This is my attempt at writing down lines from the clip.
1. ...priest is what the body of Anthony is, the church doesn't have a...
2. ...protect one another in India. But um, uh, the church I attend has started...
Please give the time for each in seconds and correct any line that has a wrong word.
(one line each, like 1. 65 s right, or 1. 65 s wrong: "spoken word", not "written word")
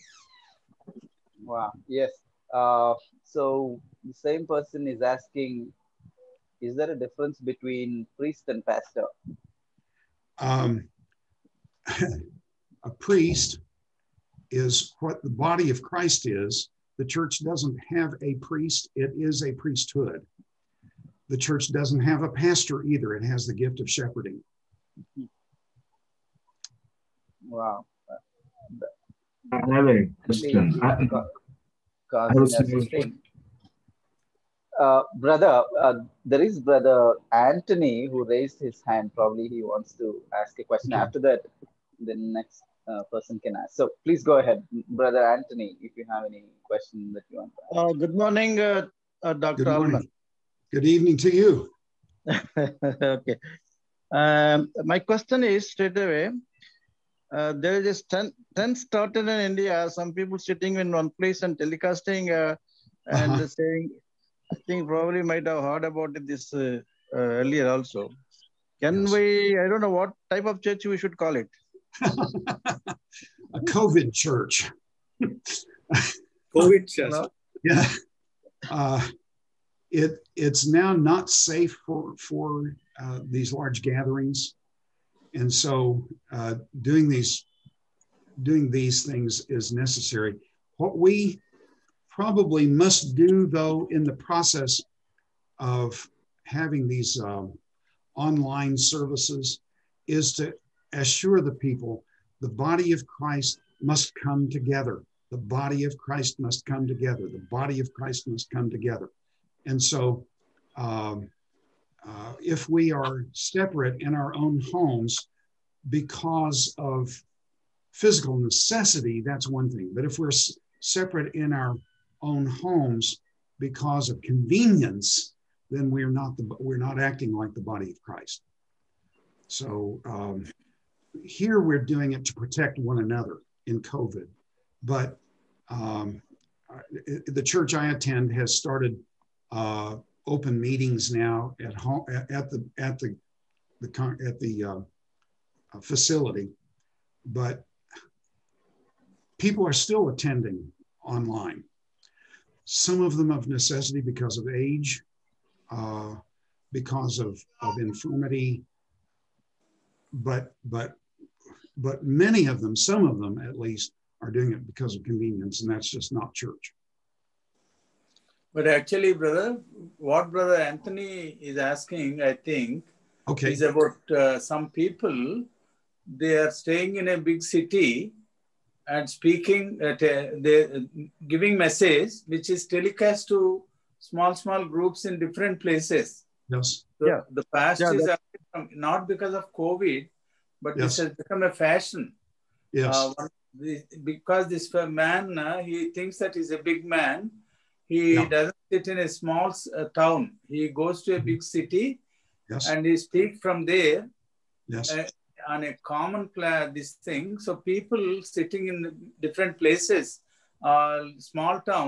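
1. 12 s wrong: "Christ", not "Anthony"
2. 132 s wrong: "COVID", not "India".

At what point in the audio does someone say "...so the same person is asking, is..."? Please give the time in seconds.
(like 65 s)
3 s.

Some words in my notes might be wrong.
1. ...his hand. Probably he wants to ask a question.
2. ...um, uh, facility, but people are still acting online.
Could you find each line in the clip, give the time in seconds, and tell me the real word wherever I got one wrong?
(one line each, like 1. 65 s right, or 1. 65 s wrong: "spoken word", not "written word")
1. 38 s right
2. 144 s wrong: "attending", not "acting".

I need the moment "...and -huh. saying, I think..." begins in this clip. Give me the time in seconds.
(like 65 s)
63 s.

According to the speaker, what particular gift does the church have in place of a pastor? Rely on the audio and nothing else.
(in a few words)
The gift of shepherding.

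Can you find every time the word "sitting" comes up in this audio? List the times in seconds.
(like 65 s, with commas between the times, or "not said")
60 s, 208 s.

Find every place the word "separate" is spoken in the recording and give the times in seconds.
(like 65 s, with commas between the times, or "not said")
113 s, 120 s.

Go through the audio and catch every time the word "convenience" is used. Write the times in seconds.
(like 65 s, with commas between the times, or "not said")
124 s, 165 s.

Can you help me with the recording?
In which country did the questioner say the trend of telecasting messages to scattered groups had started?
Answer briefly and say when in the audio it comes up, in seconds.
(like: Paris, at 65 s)
India, at 59 s.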